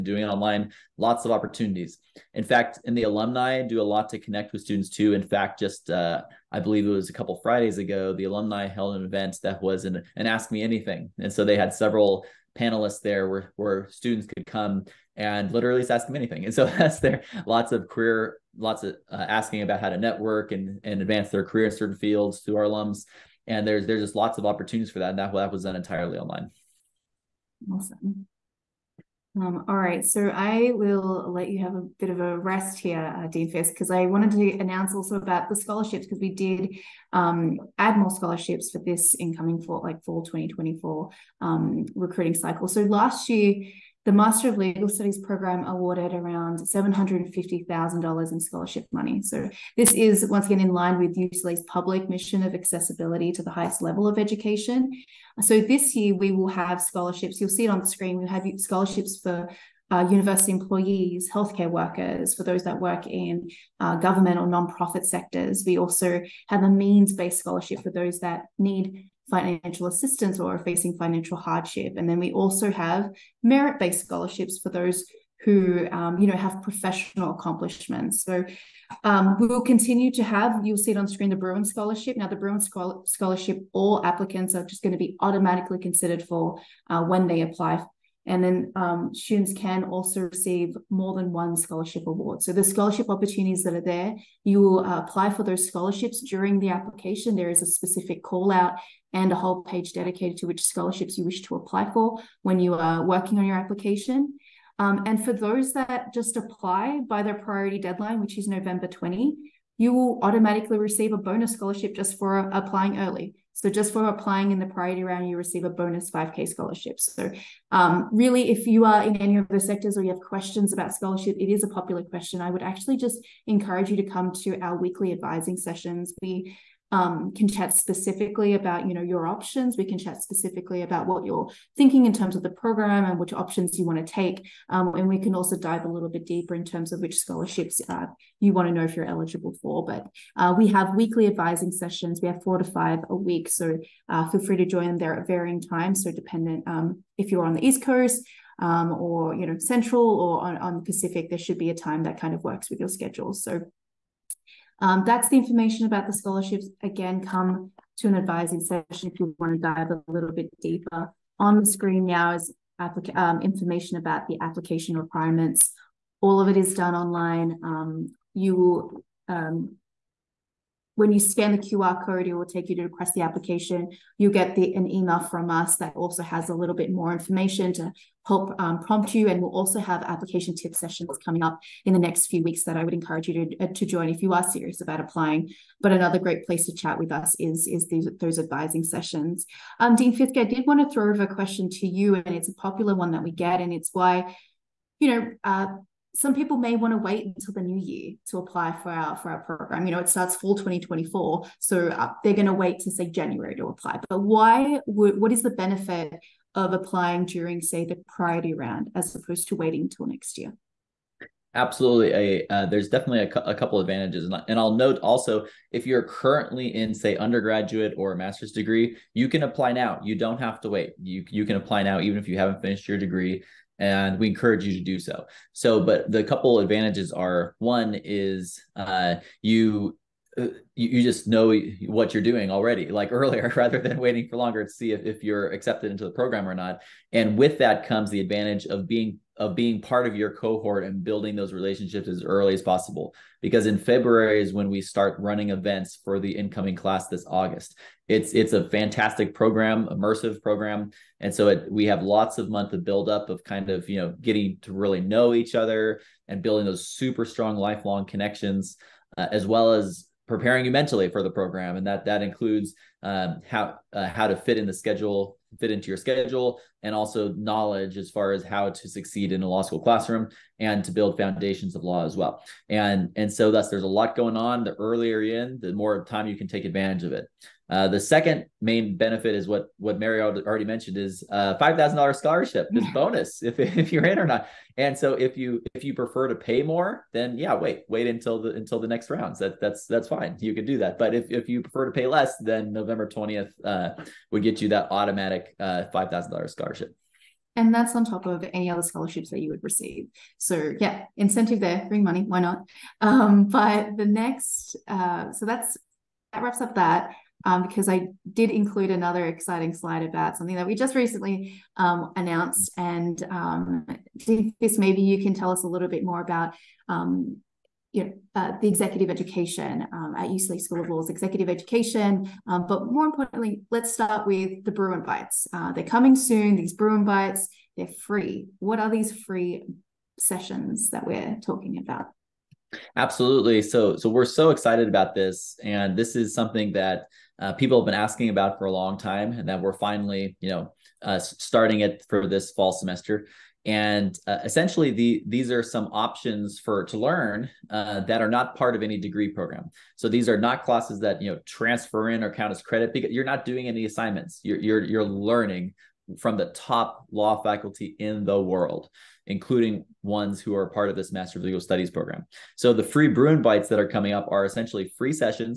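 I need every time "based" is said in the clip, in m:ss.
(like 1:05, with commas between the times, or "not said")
1:07, 1:13.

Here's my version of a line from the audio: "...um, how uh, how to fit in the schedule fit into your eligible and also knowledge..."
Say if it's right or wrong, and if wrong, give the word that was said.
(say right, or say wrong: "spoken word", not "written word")
wrong: "schedule", not "eligible".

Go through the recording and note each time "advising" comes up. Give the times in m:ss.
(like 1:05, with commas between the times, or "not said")
2:05, 2:21, 2:38, 3:08.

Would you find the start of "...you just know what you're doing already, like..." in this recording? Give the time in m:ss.
3:50.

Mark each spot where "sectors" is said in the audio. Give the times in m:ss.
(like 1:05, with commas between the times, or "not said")
1:05, 1:59.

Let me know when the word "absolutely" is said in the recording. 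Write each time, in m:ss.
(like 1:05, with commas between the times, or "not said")
3:31, 5:32.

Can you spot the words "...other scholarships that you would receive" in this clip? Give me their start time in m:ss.
4:58.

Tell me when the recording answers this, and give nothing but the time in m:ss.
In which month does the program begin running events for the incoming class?
4:03.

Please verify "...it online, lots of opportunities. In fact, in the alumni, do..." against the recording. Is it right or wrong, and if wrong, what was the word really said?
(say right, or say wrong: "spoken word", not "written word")
right.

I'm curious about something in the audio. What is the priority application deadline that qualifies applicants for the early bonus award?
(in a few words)
November 20.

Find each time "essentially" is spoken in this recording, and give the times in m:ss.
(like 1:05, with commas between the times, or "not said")
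5:44, 6:04.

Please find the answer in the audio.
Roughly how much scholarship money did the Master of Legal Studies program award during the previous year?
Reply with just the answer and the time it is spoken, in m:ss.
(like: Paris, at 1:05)
$750,000, at 0:46.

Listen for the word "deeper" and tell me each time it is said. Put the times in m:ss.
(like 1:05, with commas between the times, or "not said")
2:16, 2:40.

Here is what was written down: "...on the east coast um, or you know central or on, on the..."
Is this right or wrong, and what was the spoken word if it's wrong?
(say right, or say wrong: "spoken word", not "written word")
right.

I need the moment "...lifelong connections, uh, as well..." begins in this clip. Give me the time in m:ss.
4:17.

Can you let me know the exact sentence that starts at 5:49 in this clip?
So these are not classes that you know transfer in or count as credit because you're not doing any assignments.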